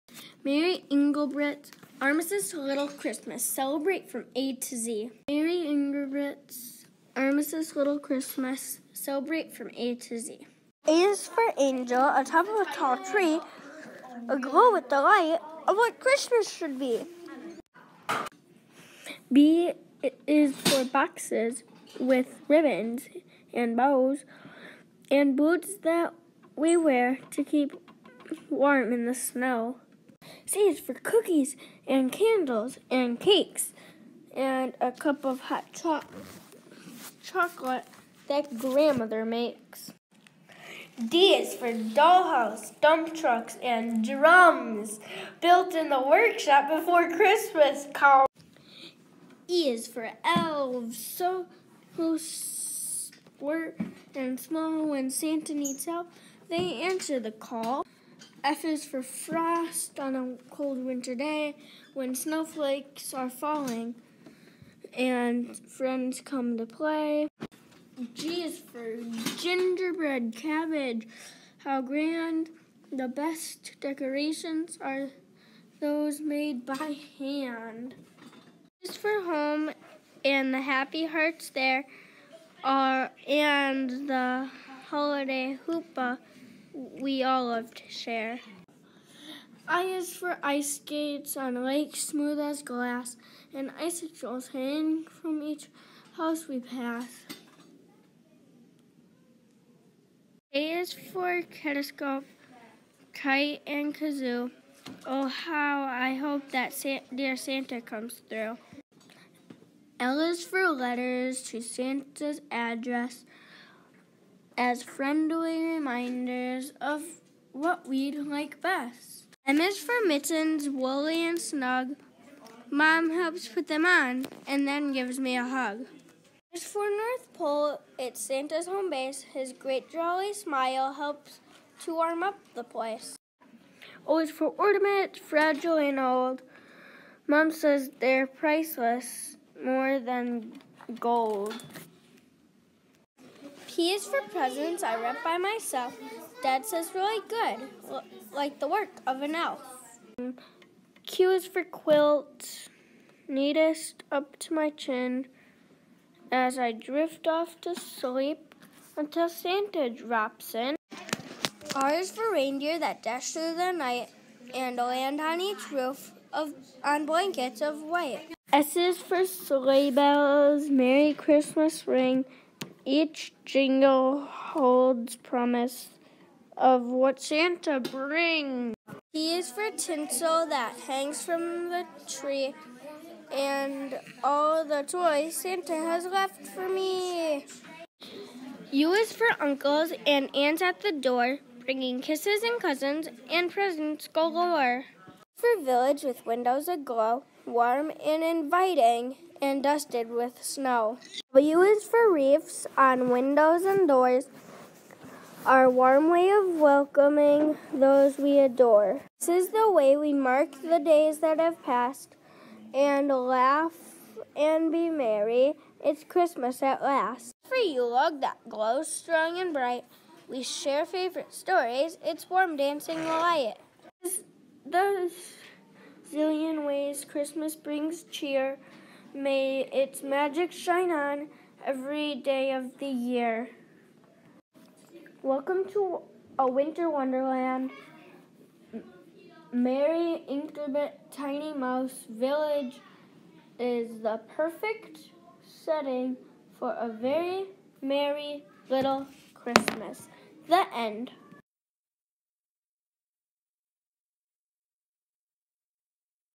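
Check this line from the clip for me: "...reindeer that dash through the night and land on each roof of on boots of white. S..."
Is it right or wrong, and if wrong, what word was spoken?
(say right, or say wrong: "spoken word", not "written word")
wrong: "blankets", not "boots".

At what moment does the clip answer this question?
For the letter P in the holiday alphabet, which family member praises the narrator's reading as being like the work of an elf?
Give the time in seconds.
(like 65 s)
146 s.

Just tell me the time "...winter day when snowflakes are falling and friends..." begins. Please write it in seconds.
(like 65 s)
60 s.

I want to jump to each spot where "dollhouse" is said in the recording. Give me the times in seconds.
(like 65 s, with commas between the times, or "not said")
41 s.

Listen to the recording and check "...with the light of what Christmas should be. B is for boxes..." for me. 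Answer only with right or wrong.
right.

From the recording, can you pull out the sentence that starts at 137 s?
Mom says they're priceless, more than gold.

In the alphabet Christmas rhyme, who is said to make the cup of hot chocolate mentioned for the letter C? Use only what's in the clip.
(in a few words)
grandmother.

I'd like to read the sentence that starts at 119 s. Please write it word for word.
M is for mittens, woolly and snug.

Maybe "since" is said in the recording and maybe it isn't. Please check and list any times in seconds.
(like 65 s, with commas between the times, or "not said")
not said.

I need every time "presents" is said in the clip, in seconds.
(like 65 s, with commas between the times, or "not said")
144 s, 193 s.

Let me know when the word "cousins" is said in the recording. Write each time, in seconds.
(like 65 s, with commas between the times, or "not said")
192 s.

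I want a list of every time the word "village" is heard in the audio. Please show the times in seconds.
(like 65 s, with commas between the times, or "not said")
195 s, 242 s.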